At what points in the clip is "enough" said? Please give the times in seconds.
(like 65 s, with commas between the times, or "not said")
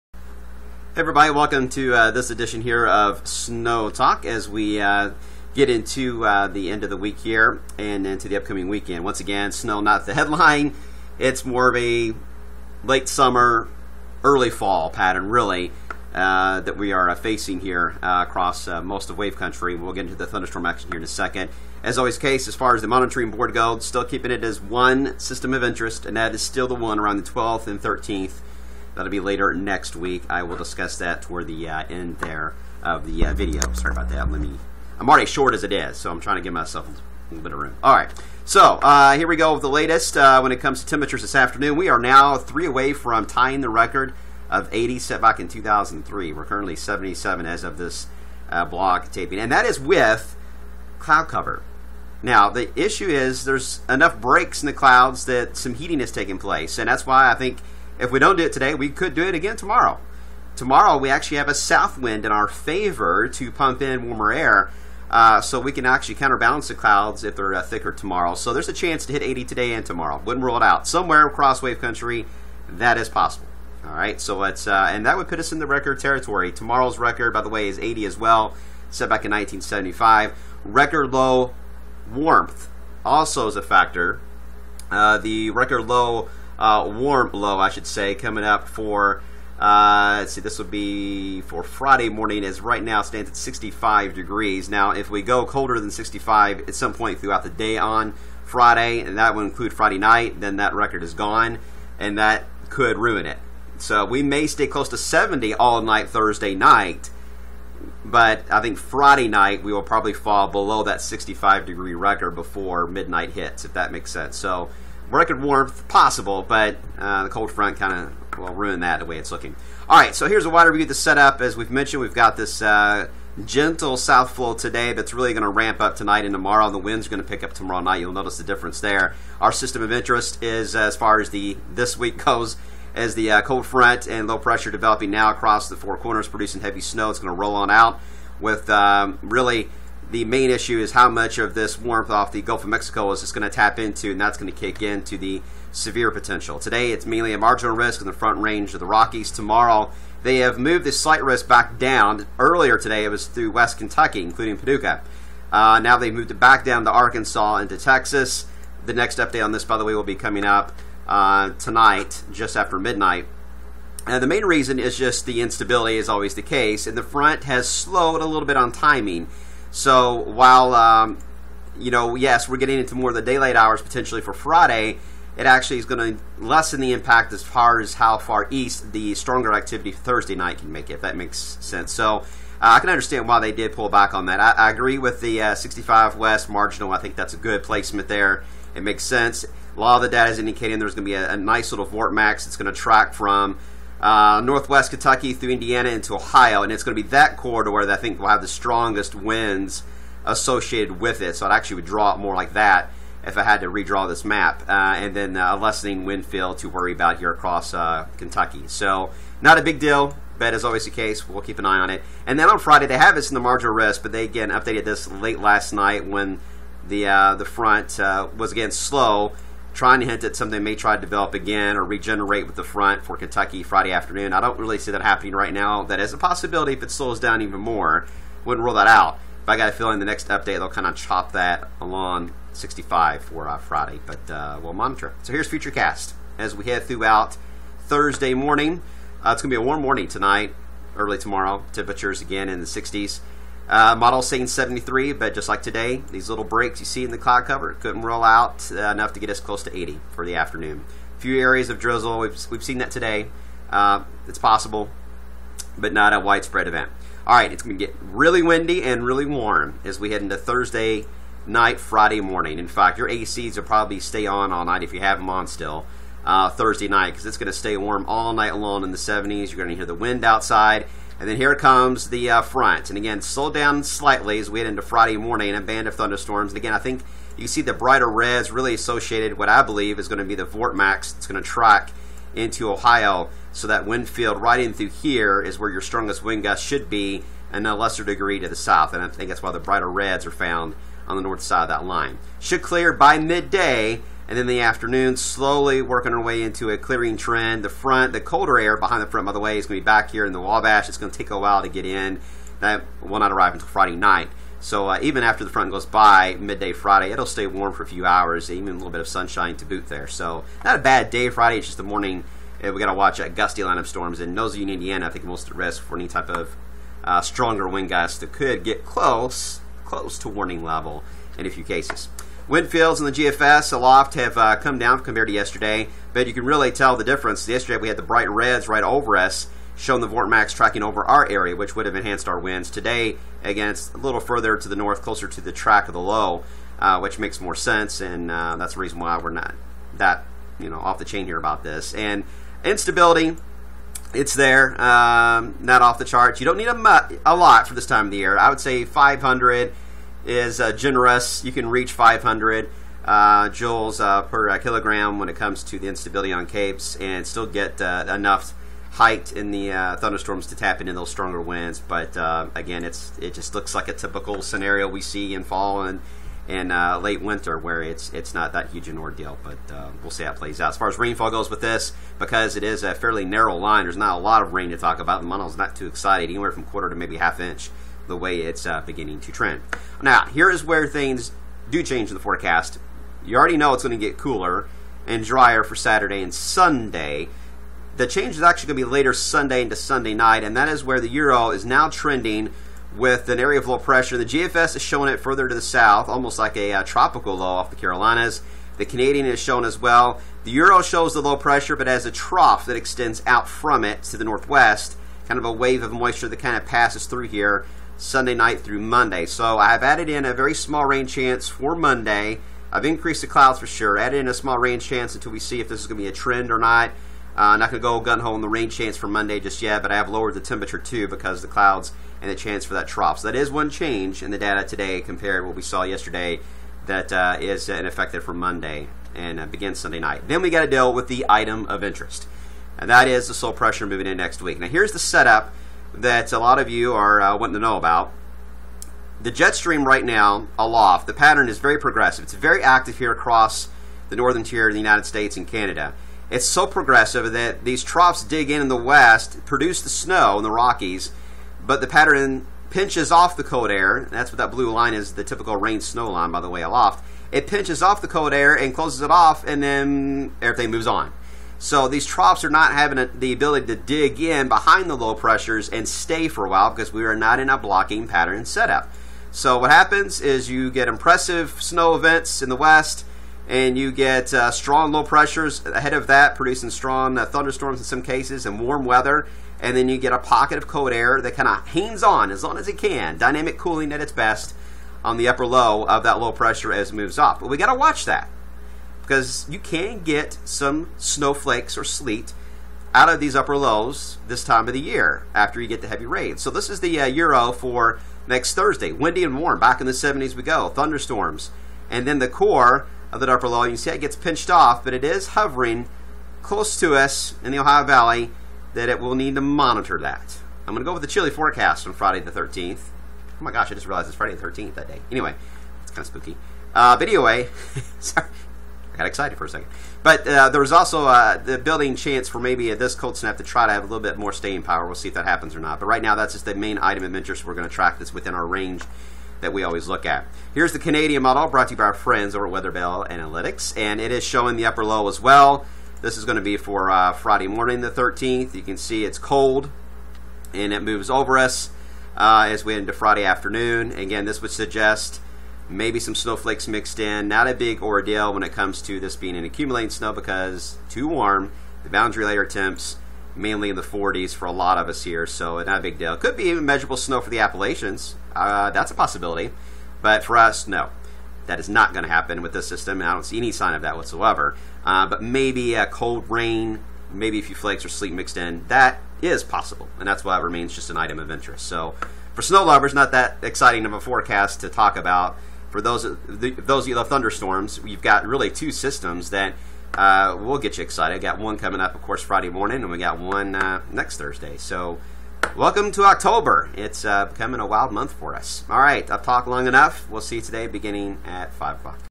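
53 s, 248 s, 357 s, 589 s.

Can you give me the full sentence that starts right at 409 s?
So I've added in a very small rain chance for Monday.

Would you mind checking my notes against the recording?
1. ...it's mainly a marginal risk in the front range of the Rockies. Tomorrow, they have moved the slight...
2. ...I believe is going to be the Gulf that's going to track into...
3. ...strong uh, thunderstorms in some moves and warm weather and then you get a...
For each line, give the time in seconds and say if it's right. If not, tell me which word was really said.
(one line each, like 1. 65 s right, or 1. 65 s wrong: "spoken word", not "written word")
1. 146 s right
2. 279 s wrong: "Vortmax", not "Gulf"
3. 476 s wrong: "cases", not "moves".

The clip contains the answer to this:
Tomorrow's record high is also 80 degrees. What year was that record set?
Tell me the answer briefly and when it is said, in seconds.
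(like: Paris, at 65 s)
1975, at 79 s.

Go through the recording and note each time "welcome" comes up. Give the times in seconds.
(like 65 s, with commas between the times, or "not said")
1 s, 585 s.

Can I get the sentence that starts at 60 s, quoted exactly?
Tomorrow, we actually have a south wind in our favor to pump in warmer air.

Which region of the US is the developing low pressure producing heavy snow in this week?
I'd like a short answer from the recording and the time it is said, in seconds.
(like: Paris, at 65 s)
Four Corners, at 135 s.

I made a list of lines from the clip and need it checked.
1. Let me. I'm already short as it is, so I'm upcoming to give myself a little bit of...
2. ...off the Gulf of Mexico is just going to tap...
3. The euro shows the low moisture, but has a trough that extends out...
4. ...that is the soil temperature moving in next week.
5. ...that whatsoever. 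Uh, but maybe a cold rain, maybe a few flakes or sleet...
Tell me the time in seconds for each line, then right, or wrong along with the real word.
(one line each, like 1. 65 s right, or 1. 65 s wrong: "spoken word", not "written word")
1. 34 s wrong: "trying", not "upcoming"
2. 142 s right
3. 400 s wrong: "pressure", not "moisture"
4. 432 s wrong: "pressure", not "temperature"
5. 563 s right.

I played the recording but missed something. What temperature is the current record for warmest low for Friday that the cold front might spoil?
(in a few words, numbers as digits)
65 degrees.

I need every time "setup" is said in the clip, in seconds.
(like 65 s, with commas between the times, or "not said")
120 s, 434 s, 468 s.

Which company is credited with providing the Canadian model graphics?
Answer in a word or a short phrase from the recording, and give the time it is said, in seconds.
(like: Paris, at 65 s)
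Weatherbell Analytics, at 532 s.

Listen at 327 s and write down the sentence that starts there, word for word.
Yesterday we had the bright reds right over us, showing the Vortmax tracking over our area, which would have enhanced our winds.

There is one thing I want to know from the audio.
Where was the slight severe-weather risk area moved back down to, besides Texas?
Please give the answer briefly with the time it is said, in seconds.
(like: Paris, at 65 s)
Arkansas, at 156 s.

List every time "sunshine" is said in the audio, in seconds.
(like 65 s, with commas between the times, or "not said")
309 s.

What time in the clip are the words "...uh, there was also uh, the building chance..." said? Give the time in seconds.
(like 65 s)
520 s.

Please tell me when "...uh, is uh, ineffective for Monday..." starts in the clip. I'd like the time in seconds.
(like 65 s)
427 s.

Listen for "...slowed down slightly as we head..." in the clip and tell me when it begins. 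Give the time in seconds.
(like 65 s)
273 s.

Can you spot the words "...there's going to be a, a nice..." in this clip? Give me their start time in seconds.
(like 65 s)
190 s.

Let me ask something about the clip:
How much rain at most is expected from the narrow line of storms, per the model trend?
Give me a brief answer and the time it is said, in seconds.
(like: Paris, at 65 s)
half inch, at 377 s.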